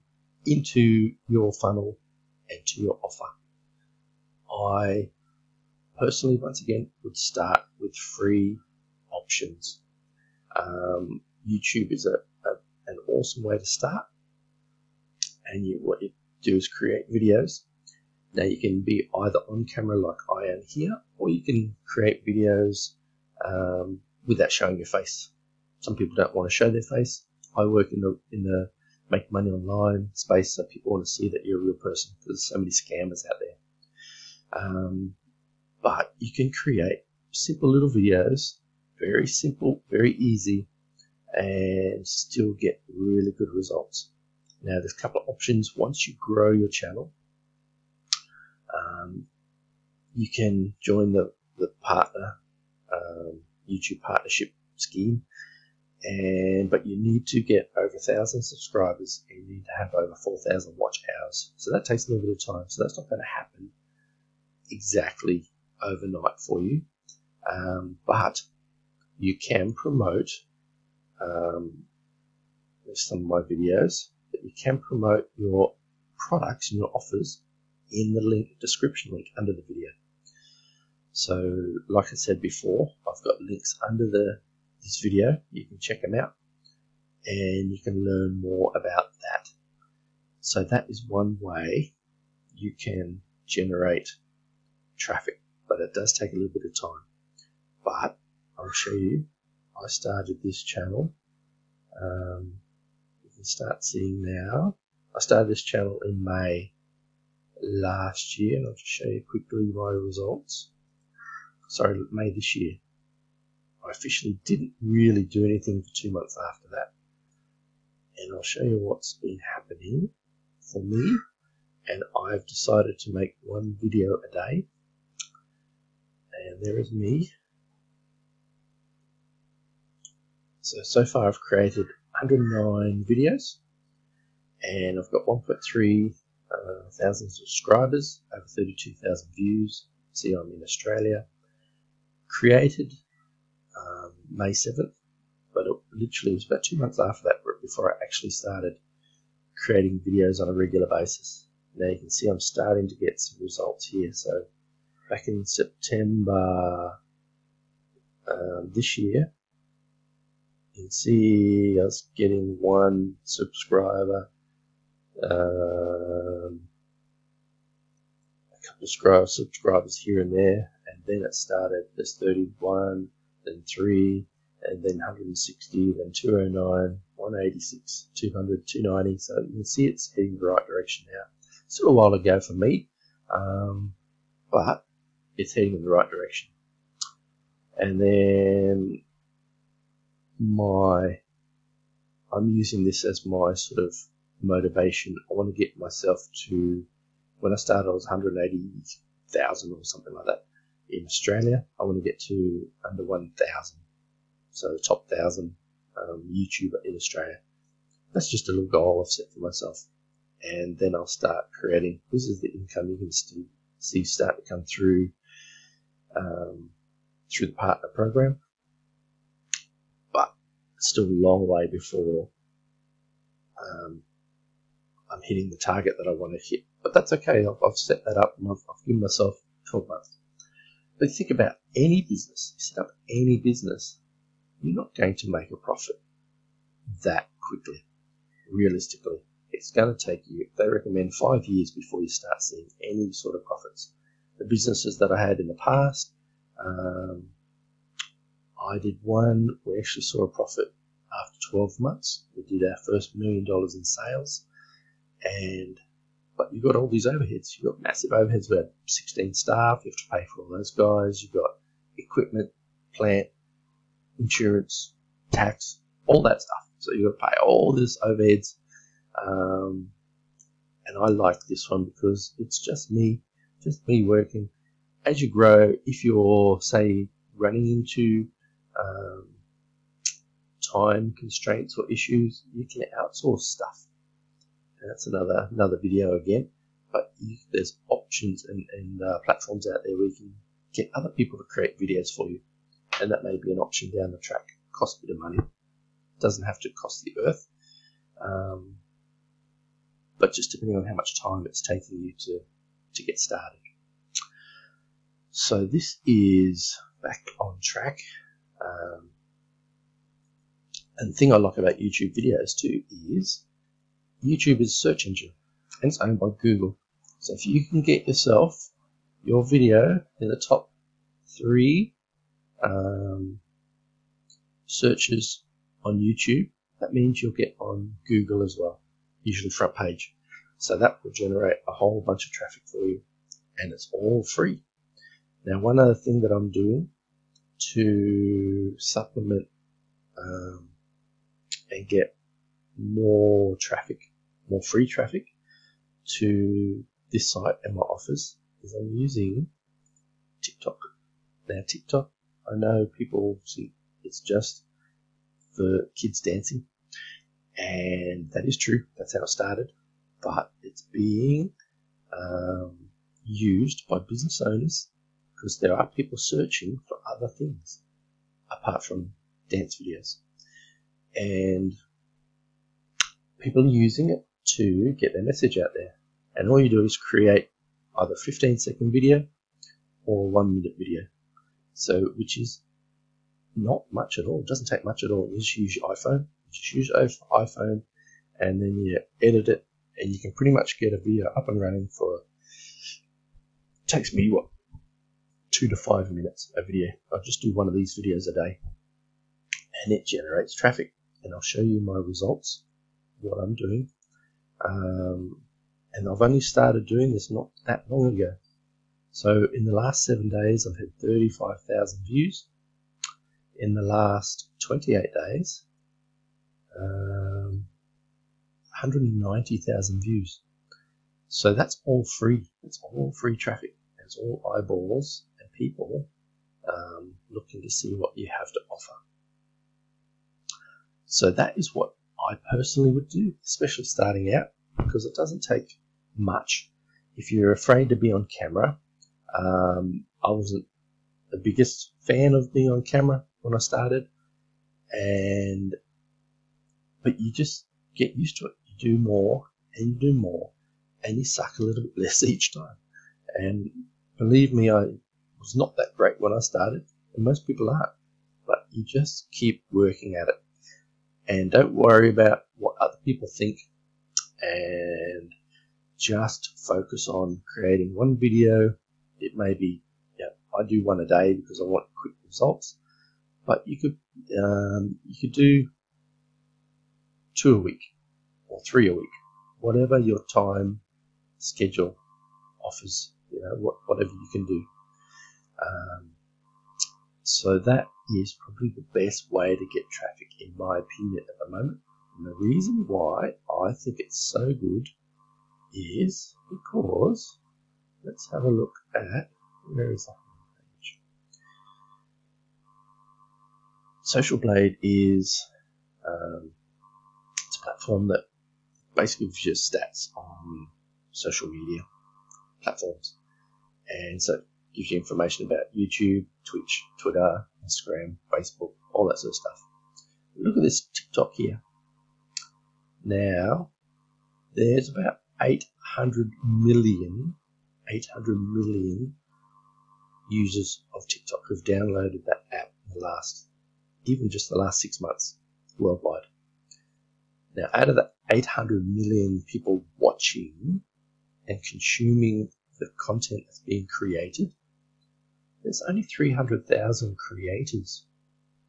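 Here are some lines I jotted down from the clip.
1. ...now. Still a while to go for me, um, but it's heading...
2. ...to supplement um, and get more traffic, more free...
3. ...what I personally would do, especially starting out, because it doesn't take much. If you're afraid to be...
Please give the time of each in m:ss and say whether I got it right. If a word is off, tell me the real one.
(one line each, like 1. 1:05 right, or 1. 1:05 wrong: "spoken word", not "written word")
1. 3:01 right
2. 5:37 right
3. 7:11 right.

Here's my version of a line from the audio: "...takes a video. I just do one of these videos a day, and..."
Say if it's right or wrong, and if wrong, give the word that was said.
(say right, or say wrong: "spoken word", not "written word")
wrong: "minutes", not "takes".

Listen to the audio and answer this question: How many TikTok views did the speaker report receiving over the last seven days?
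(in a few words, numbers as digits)
35,000.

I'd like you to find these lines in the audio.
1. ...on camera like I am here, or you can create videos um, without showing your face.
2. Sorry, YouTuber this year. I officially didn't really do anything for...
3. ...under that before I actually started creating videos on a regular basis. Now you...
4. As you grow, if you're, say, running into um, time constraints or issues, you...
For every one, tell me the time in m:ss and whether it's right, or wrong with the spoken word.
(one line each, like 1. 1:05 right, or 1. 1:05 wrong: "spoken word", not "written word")
1. 0:19 right
2. 1:51 wrong: "May", not "YouTuber"
3. 2:26 wrong: "after", not "under"
4. 4:35 right.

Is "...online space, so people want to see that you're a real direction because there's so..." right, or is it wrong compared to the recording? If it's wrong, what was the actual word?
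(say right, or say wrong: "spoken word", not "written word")
wrong: "person", not "direction".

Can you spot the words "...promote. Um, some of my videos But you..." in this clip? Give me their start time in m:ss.
1:09.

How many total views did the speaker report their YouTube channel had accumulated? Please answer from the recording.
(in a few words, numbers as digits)
32,000.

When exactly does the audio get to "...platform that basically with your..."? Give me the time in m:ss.
8:27.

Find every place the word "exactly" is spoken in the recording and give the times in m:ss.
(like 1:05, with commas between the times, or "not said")
1:04.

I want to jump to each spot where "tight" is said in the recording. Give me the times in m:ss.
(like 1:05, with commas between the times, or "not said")
not said.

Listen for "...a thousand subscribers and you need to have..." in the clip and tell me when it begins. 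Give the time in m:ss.
0:57.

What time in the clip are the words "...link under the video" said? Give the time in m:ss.
1:19.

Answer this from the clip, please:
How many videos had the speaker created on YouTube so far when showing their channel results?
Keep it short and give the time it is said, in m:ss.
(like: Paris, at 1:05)
109, at 2:12.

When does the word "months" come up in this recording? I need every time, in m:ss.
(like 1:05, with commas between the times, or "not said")
1:56, 2:26, 3:49, 4:11, 8:54.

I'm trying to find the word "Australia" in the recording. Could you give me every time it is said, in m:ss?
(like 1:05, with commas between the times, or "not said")
2:20, 3:21, 3:26.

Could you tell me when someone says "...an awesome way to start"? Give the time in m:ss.
0:12.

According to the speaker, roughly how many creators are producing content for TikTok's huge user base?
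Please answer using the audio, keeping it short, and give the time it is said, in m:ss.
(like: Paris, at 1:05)
300,000, at 9:06.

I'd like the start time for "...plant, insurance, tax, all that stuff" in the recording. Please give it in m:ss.
4:22.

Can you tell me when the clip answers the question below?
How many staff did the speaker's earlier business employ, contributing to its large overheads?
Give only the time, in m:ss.
4:18.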